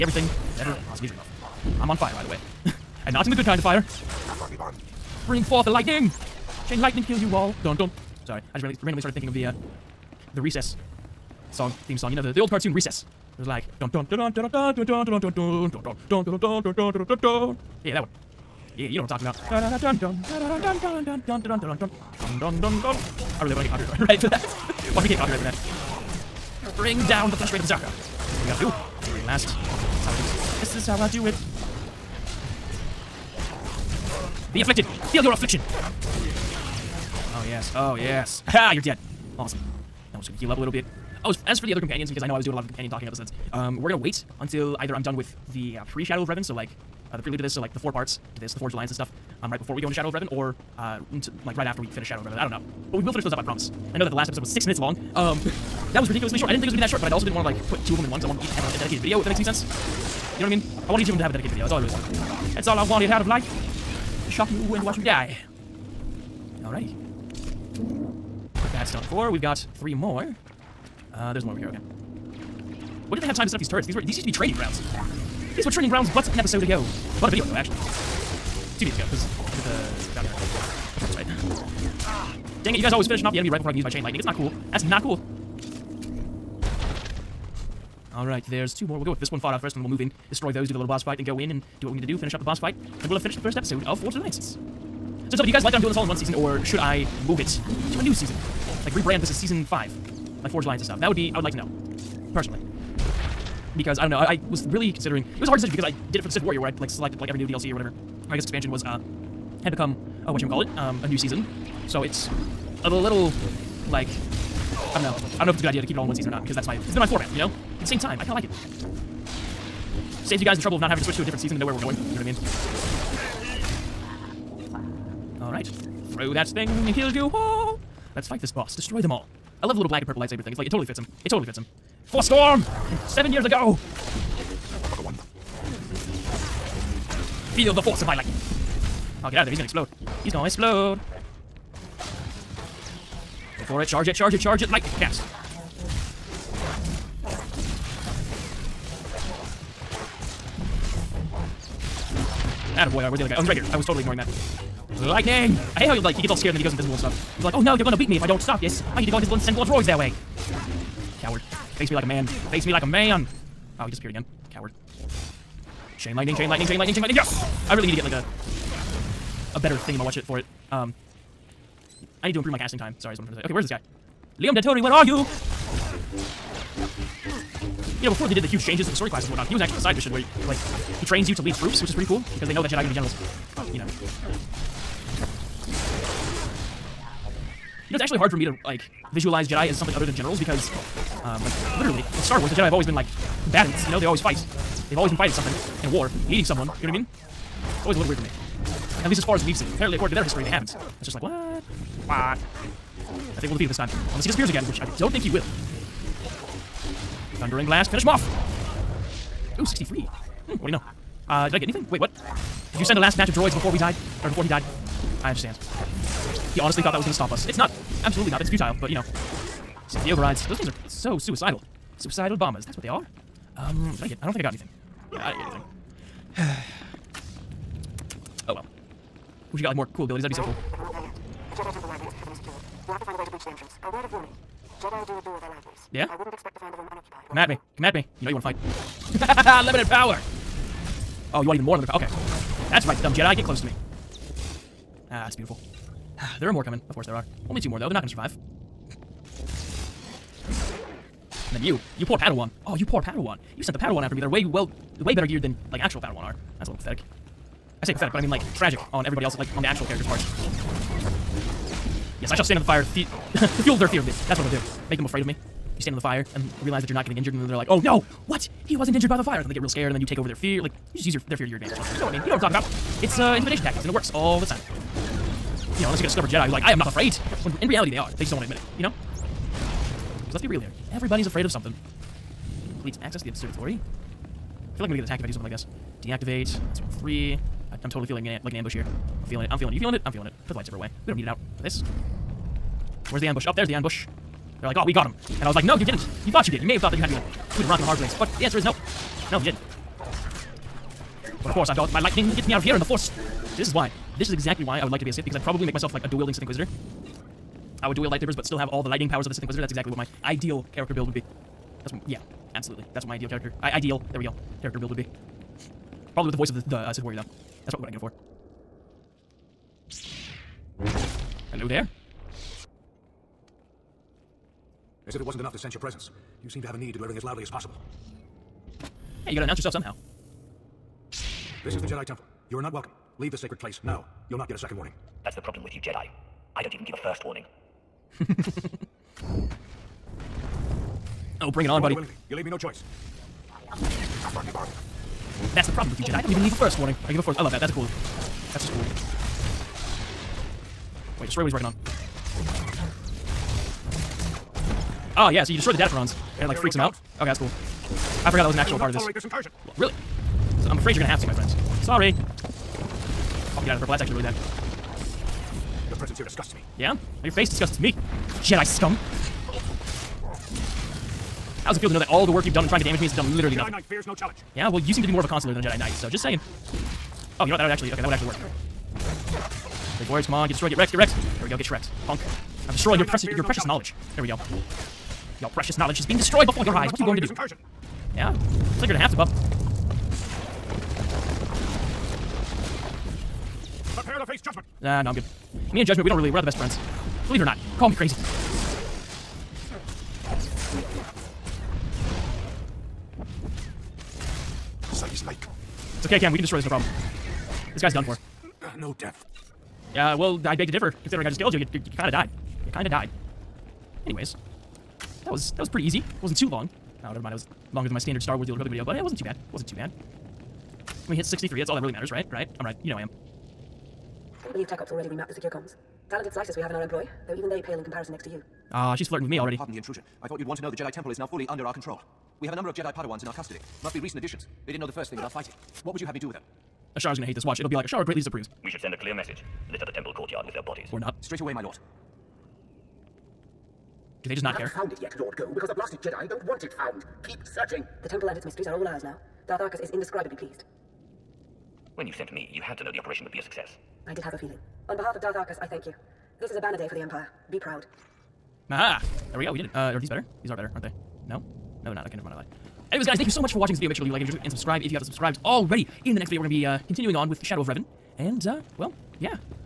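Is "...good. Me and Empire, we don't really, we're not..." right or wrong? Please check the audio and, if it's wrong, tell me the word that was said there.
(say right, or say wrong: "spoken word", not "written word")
wrong: "Judgment", not "Empire".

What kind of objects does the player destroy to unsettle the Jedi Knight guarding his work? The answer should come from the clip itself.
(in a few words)
Datacrons.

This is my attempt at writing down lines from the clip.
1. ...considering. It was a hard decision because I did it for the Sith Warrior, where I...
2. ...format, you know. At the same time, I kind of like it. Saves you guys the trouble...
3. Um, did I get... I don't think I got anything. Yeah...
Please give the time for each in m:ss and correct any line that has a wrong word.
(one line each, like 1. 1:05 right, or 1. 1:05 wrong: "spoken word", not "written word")
1. 1:44 right
2. 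1:57 right
3. 3:43 right.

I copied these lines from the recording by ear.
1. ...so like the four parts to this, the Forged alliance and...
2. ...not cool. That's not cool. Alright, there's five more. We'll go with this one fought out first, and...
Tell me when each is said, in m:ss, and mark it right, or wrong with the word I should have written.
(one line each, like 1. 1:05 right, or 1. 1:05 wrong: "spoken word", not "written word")
1. 0:47 right
2. 1:24 wrong: "two", not "five".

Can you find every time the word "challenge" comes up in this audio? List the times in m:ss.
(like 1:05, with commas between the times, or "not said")
6:14, 6:23.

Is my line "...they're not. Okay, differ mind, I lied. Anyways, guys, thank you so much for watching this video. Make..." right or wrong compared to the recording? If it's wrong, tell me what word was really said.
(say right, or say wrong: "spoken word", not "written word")
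wrong: "never", not "differ".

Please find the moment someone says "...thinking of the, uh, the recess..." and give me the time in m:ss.
0:09.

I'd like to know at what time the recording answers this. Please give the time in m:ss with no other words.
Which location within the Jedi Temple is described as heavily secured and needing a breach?
3:51.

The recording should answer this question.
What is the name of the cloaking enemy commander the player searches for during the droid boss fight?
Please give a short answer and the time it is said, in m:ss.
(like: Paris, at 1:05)
Liam Dentori, at 2:54.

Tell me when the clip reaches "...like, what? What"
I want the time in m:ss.
3:21.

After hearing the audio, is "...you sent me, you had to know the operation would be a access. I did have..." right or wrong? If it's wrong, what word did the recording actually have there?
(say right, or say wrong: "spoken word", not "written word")
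wrong: "success", not "access".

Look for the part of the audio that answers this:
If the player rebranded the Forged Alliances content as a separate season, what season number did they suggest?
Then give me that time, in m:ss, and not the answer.
1:39.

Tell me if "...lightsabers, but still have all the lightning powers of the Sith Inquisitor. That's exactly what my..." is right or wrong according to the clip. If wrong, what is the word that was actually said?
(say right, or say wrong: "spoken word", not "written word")
right.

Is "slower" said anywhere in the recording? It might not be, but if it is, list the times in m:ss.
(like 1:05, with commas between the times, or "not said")
not said.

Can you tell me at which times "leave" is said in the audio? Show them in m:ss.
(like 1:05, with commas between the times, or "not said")
5:33, 5:42, 5:46, 7:44.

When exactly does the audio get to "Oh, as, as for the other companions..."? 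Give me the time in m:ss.
0:41.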